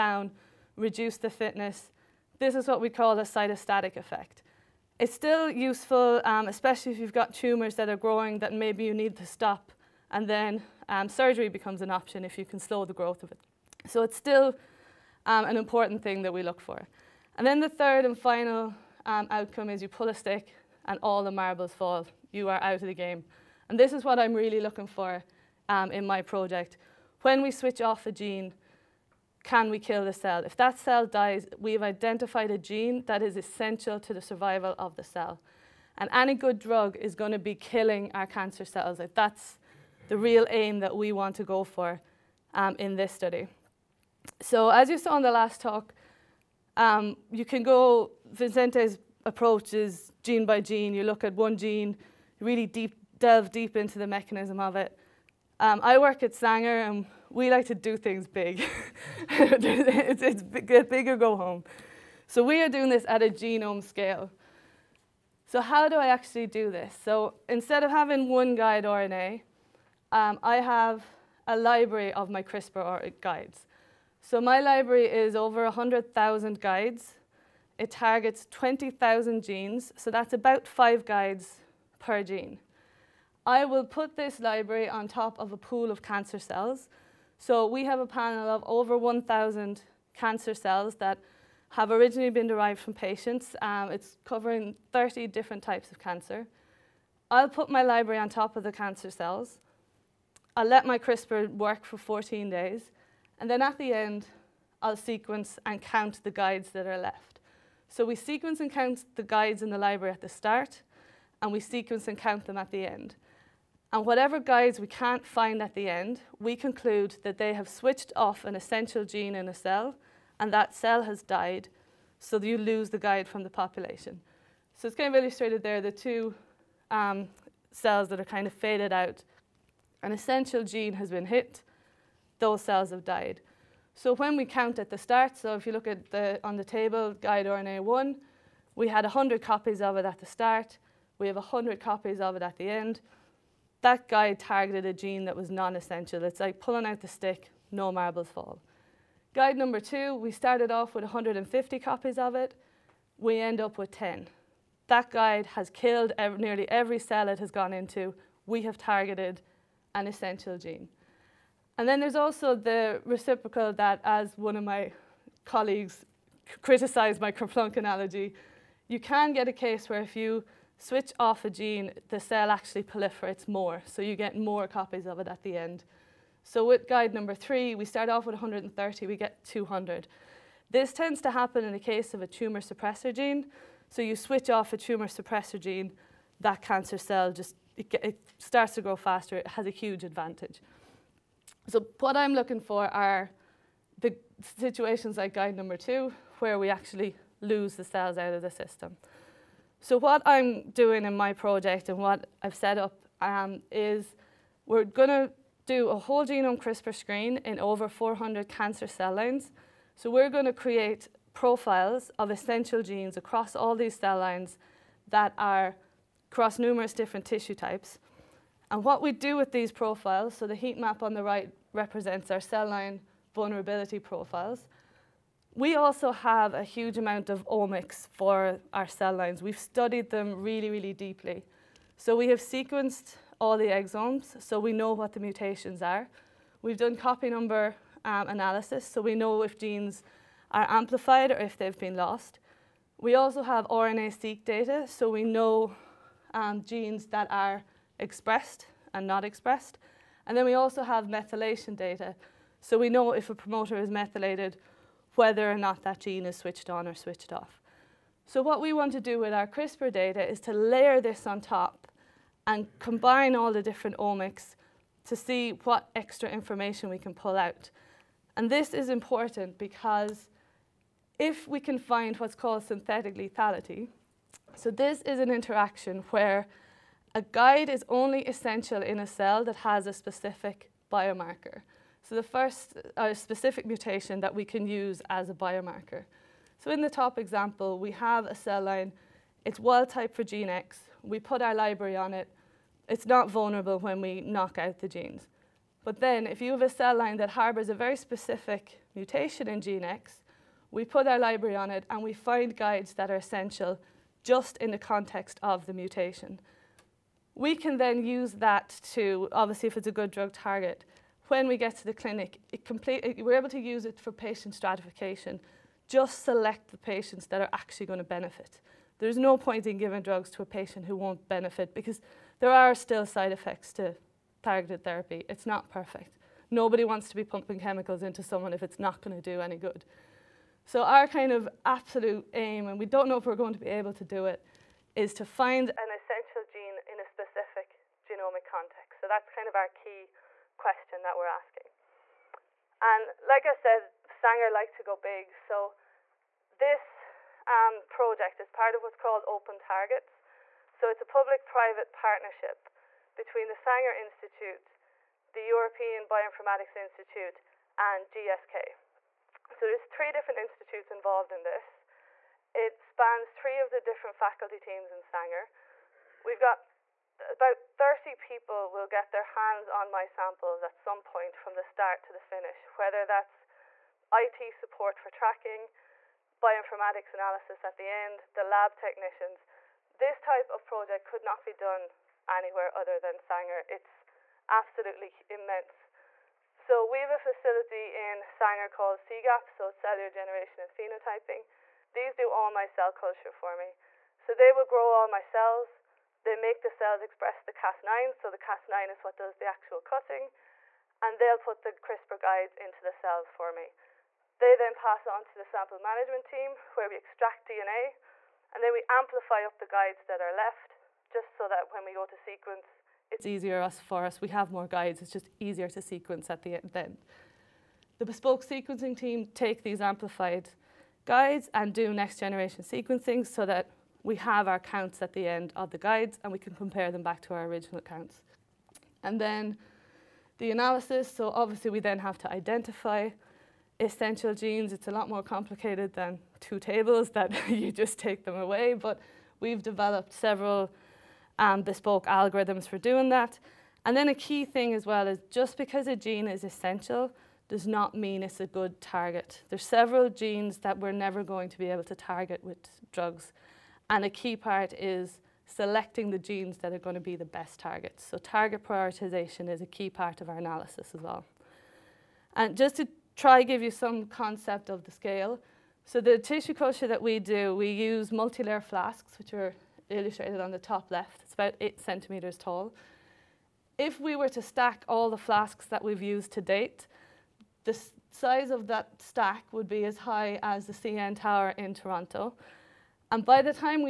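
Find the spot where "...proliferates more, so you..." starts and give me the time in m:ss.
2:52.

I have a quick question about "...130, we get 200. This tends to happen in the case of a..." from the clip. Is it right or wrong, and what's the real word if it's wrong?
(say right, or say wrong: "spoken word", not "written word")
right.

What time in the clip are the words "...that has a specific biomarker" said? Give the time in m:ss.
4:39.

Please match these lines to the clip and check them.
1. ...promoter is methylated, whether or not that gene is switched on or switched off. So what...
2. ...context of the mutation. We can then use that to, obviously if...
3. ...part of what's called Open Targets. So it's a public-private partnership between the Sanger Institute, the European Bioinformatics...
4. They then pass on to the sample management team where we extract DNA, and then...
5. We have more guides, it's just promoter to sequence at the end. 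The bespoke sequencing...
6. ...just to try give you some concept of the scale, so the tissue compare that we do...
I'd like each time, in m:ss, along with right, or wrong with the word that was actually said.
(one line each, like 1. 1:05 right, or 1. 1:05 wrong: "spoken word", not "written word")
1. 4:13 right
2. 5:04 right
3. 5:48 right
4. 6:44 right
5. 6:54 wrong: "easier", not "promoter"
6. 7:42 wrong: "culture", not "compare".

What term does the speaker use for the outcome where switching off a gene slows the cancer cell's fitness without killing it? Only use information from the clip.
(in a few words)
cytostatic effect.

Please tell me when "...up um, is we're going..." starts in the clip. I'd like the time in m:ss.
3:22.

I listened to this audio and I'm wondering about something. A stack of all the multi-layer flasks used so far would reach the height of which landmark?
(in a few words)
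CN Tower.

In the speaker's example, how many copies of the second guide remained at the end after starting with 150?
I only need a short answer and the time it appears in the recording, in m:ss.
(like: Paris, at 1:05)
10, at 2:33.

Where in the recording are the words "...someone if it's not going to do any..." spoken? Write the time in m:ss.
5:28.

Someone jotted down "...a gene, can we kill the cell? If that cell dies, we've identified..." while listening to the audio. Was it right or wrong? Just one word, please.
right.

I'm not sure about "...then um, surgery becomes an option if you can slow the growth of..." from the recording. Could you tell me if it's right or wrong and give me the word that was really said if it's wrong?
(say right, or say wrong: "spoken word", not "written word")
right.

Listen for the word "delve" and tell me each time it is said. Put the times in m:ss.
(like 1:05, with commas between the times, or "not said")
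0:53.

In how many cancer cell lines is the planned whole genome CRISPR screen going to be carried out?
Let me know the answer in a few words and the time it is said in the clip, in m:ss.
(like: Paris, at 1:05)
400, at 3:27.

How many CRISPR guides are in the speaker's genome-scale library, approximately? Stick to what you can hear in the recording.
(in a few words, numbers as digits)
100,000.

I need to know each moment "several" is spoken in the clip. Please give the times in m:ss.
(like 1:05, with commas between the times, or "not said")
7:20, 7:29.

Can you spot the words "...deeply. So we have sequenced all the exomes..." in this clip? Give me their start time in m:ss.
3:50.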